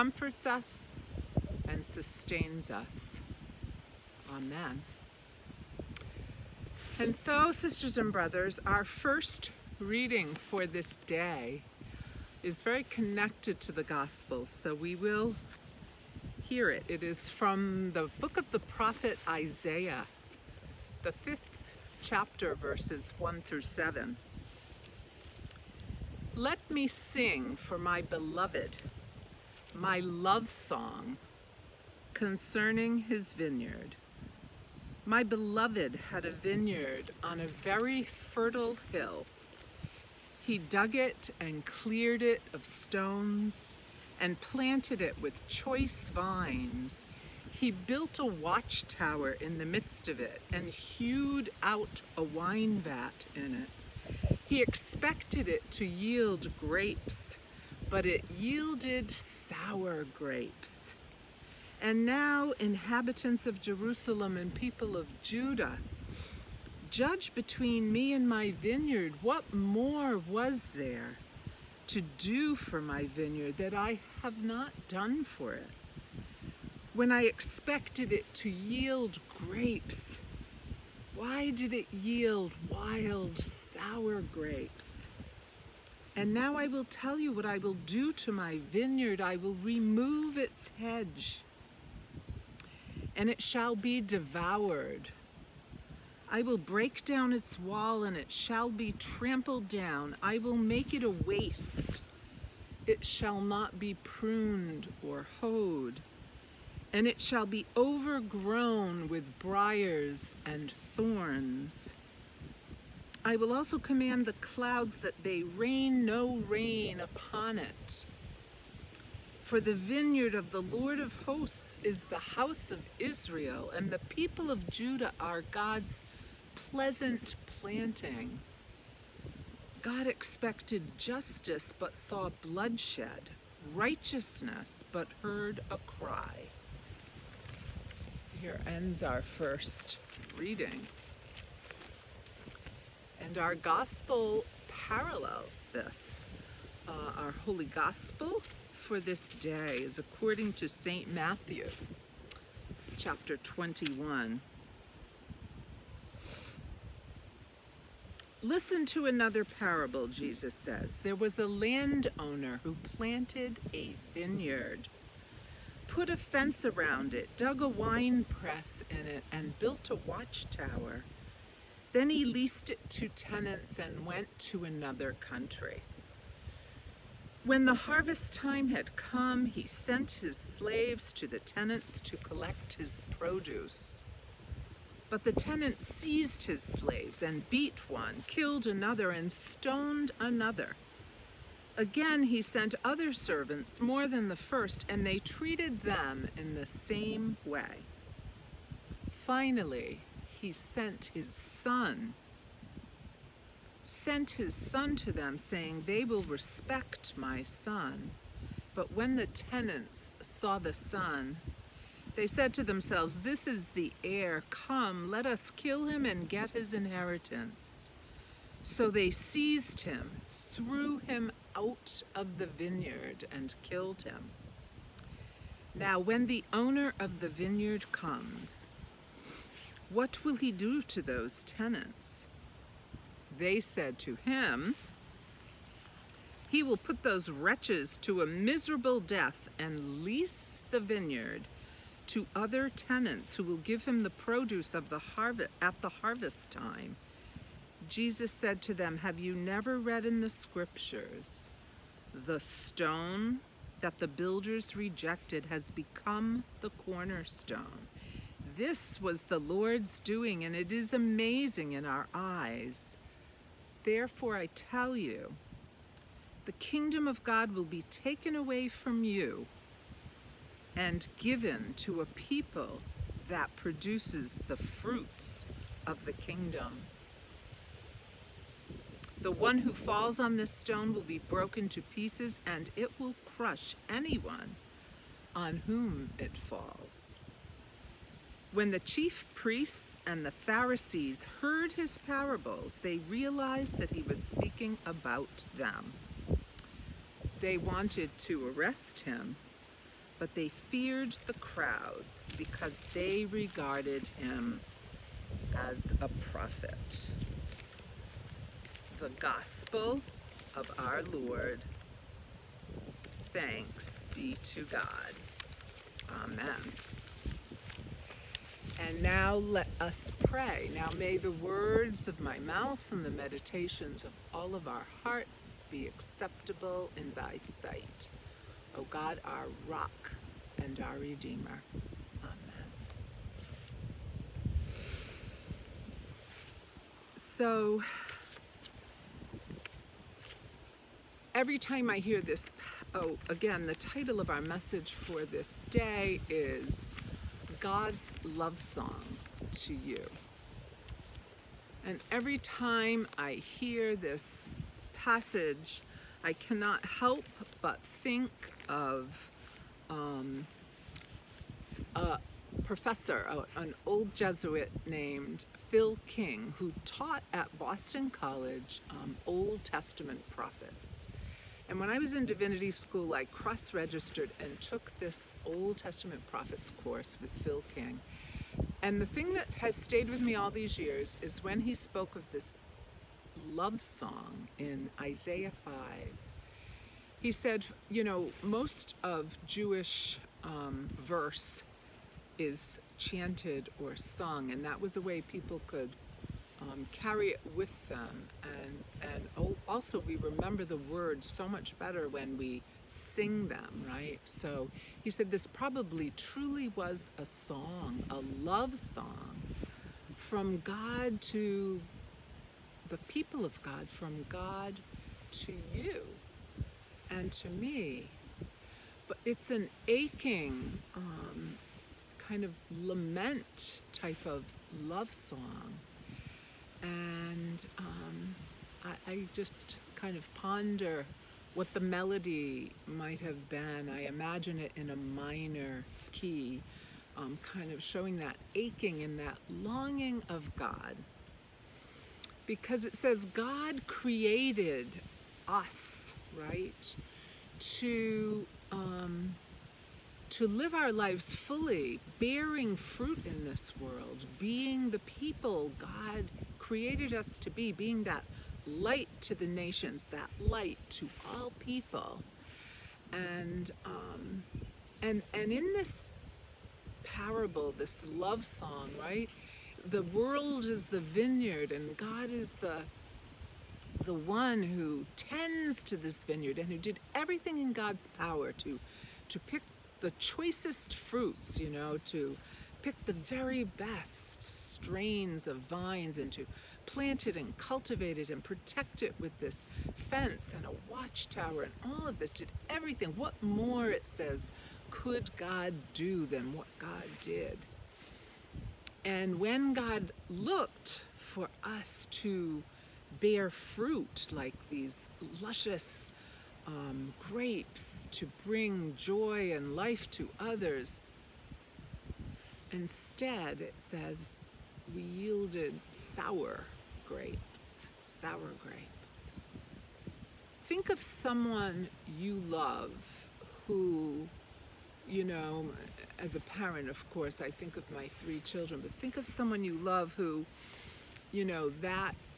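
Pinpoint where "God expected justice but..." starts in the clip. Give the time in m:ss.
2:09.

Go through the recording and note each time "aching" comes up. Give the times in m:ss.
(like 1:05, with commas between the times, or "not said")
6:59, 7:18.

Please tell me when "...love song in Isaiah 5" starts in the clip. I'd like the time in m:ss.
6:23.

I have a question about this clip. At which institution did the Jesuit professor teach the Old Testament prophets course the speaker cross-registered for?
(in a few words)
Boston College.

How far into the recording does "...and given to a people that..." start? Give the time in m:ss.
4:30.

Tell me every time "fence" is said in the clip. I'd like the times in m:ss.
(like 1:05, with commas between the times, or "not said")
2:46, 8:09.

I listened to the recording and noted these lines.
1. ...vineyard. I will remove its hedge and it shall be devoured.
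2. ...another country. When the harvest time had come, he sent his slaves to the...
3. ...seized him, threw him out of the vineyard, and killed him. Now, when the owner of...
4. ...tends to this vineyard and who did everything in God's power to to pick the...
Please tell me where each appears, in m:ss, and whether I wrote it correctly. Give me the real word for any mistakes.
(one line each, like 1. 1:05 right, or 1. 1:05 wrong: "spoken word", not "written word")
1. 1:28 right
2. 2:54 right
3. 3:39 right
4. 7:55 right.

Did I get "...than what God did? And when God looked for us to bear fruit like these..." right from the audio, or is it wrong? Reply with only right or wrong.
right.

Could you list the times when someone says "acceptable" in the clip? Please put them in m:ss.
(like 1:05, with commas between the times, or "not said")
5:25.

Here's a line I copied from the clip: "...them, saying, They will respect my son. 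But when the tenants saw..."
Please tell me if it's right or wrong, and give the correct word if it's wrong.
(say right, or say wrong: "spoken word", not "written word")
right.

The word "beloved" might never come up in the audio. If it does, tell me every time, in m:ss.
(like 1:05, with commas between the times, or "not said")
0:28, 0:35.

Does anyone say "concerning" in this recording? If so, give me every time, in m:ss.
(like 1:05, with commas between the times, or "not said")
0:32.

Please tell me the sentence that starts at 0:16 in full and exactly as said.
It is from the book of the prophet Isaiah, the fifth chapter, verses 1 through 7.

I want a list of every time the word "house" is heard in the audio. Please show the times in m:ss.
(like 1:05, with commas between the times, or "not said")
2:02.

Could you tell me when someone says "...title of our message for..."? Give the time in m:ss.
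5:43.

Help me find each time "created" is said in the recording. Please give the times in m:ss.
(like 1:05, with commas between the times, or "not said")
7:23, 7:36.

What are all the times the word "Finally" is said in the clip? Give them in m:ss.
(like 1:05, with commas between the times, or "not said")
3:19.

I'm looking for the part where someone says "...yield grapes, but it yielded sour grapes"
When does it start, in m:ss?
0:55.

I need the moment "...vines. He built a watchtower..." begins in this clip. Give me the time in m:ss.
0:46.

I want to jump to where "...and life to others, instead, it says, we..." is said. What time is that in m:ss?
8:29.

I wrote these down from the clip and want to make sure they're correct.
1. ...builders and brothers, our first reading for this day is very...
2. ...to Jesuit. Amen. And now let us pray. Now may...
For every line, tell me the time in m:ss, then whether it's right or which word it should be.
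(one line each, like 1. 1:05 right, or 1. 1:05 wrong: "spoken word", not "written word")
1. 0:07 wrong: "sisters", not "builders"
2. 5:14 wrong: "God", not "Jesuit".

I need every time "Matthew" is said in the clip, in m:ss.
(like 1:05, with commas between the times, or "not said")
2:31.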